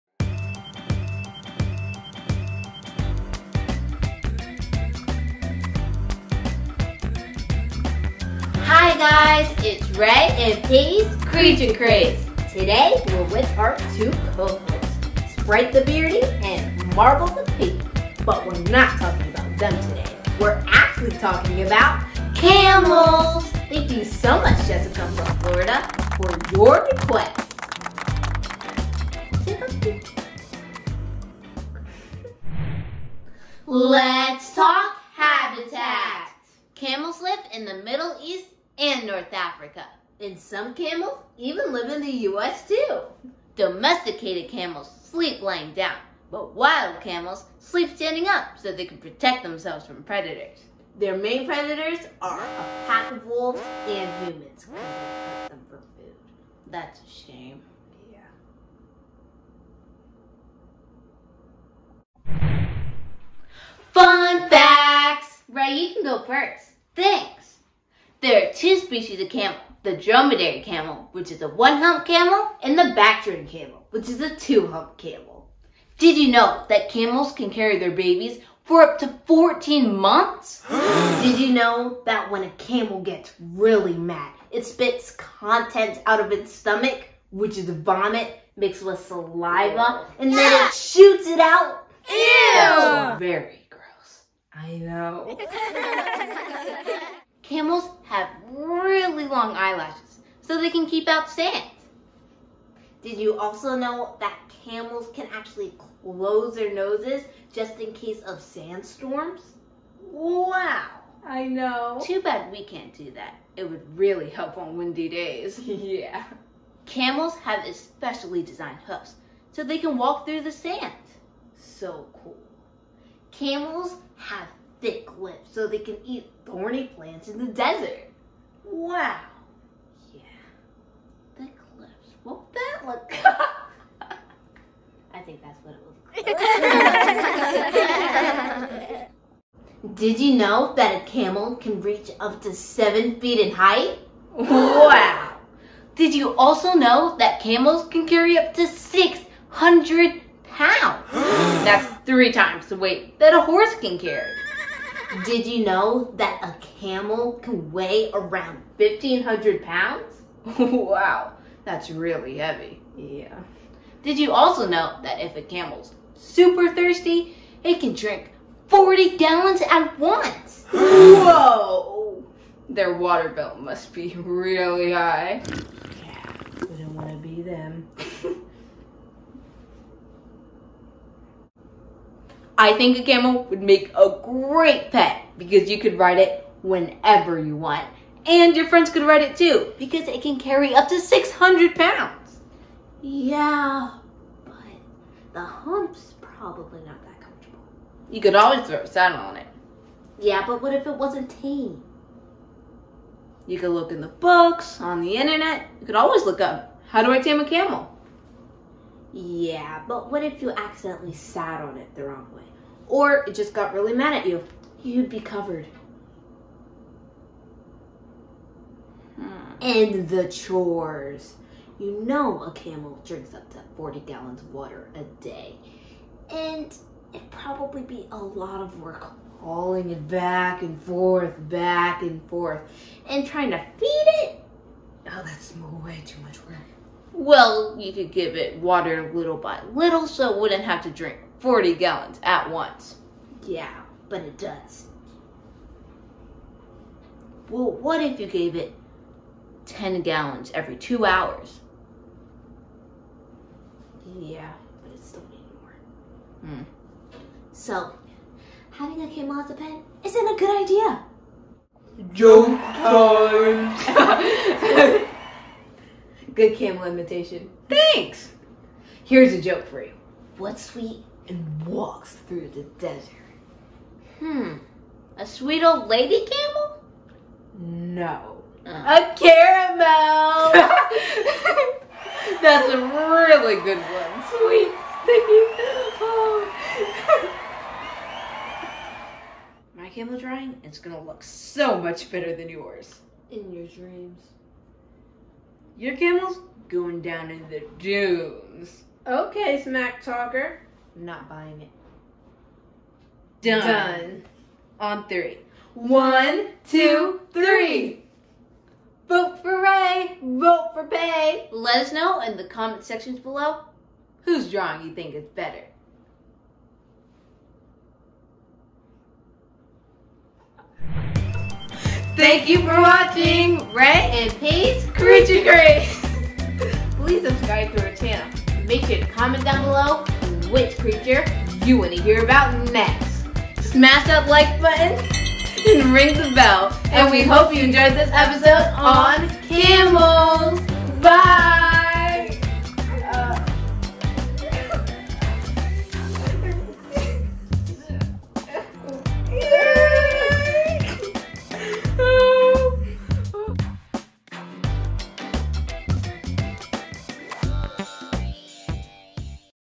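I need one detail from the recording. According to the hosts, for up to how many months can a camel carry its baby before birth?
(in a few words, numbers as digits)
14 months.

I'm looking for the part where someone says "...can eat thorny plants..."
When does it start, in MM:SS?
02:05.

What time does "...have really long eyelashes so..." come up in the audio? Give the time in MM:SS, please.
01:38.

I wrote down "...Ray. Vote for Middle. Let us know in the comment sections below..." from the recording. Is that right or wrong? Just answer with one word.
wrong.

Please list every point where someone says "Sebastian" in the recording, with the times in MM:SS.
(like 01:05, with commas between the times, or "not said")
not said.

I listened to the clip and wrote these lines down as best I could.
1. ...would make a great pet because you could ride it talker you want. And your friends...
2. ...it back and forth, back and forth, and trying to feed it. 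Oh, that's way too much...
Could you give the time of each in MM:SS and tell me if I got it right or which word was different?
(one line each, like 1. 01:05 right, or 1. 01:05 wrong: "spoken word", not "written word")
1. 03:03 wrong: "whenever", not "talker"
2. 03:49 right.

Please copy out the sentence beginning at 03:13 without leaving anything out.
Yeah, but the hump's probably not that comfortable.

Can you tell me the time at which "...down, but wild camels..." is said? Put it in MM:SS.
00:45.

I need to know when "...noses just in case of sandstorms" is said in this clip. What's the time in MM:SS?
01:46.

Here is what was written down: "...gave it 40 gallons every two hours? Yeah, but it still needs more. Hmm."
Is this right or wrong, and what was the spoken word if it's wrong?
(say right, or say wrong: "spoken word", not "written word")
wrong: "10", not "40".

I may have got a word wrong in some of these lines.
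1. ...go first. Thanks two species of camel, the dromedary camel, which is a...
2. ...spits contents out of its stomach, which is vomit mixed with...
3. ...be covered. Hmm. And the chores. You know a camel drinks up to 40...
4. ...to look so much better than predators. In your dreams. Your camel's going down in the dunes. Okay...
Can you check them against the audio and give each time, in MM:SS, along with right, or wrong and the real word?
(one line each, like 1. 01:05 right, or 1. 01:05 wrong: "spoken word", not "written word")
1. 01:06 right
2. 01:24 right
3. 03:35 right
4. 04:50 wrong: "yours", not "predators".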